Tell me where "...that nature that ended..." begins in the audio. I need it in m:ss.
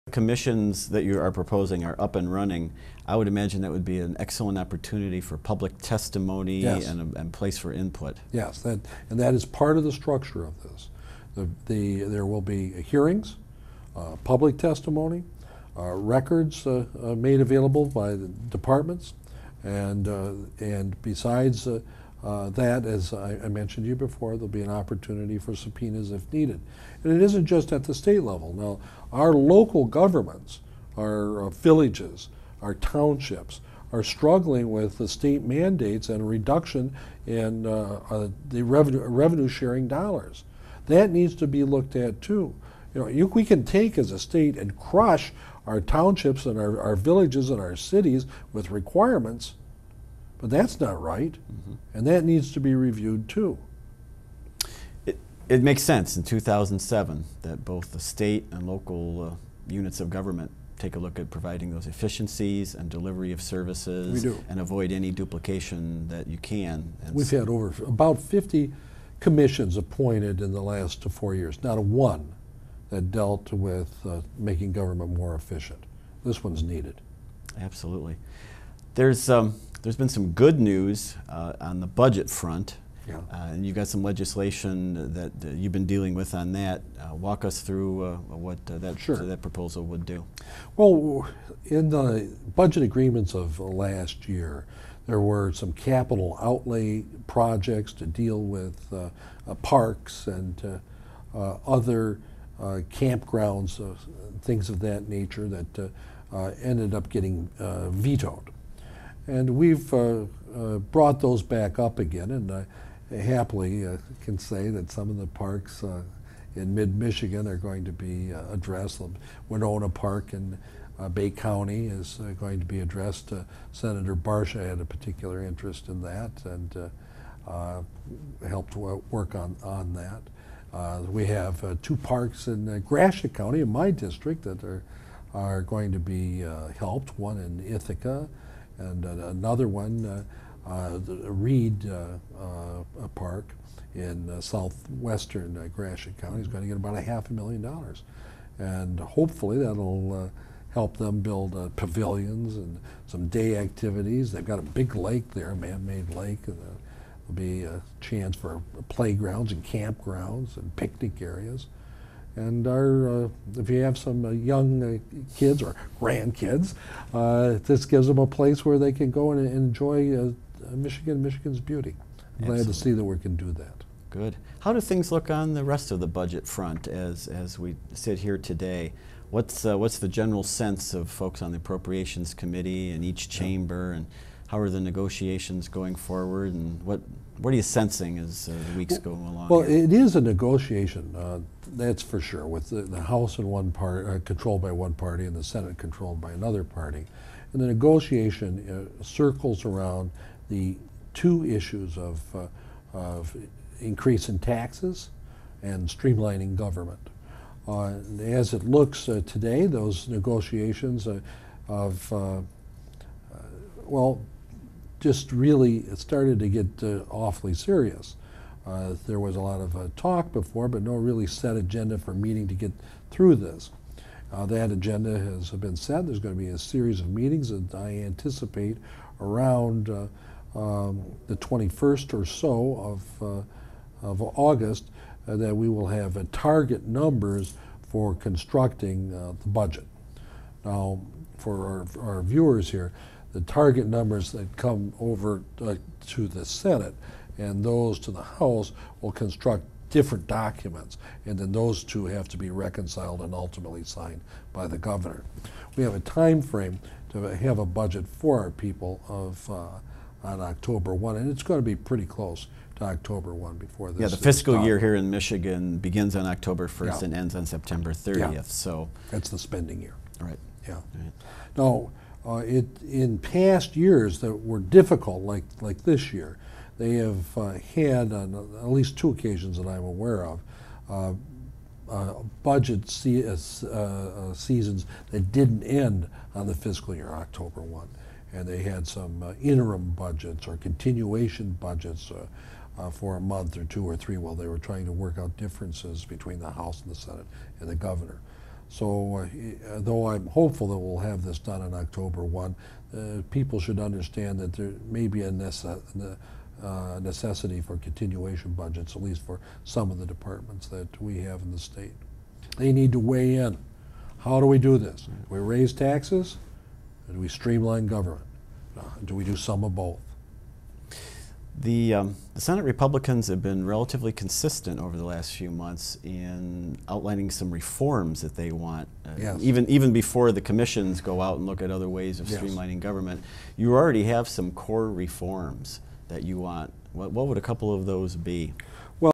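1:44.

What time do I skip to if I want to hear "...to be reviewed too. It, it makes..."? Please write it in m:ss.
0:52.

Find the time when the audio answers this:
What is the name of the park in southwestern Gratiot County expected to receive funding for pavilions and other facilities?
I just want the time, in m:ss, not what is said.
2:21.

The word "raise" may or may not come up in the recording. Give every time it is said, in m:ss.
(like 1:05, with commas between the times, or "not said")
5:15.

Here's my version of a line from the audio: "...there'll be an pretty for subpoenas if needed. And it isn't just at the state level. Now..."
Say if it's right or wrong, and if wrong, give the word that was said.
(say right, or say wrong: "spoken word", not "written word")
wrong: "opportunity", not "pretty".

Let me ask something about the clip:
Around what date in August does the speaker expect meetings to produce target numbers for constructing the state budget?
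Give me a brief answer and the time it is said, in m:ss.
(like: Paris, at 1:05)
August 21, at 3:51.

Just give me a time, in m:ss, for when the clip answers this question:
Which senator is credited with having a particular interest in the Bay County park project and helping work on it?
2:03.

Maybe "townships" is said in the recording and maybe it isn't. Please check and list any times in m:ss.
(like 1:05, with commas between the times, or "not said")
0:32, 0:45.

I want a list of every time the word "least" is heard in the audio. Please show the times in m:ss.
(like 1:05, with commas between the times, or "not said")
4:38, 5:09.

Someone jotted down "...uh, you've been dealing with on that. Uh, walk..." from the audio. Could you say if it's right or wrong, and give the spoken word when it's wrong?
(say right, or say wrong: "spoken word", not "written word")
right.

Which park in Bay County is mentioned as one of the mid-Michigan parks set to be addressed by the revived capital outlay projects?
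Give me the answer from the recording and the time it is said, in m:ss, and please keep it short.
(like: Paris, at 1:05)
Wenonah Park, at 1:59.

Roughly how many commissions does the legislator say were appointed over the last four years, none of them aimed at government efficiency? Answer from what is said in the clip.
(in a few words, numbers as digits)
50.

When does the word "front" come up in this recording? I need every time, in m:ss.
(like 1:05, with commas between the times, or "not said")
1:22, 2:56.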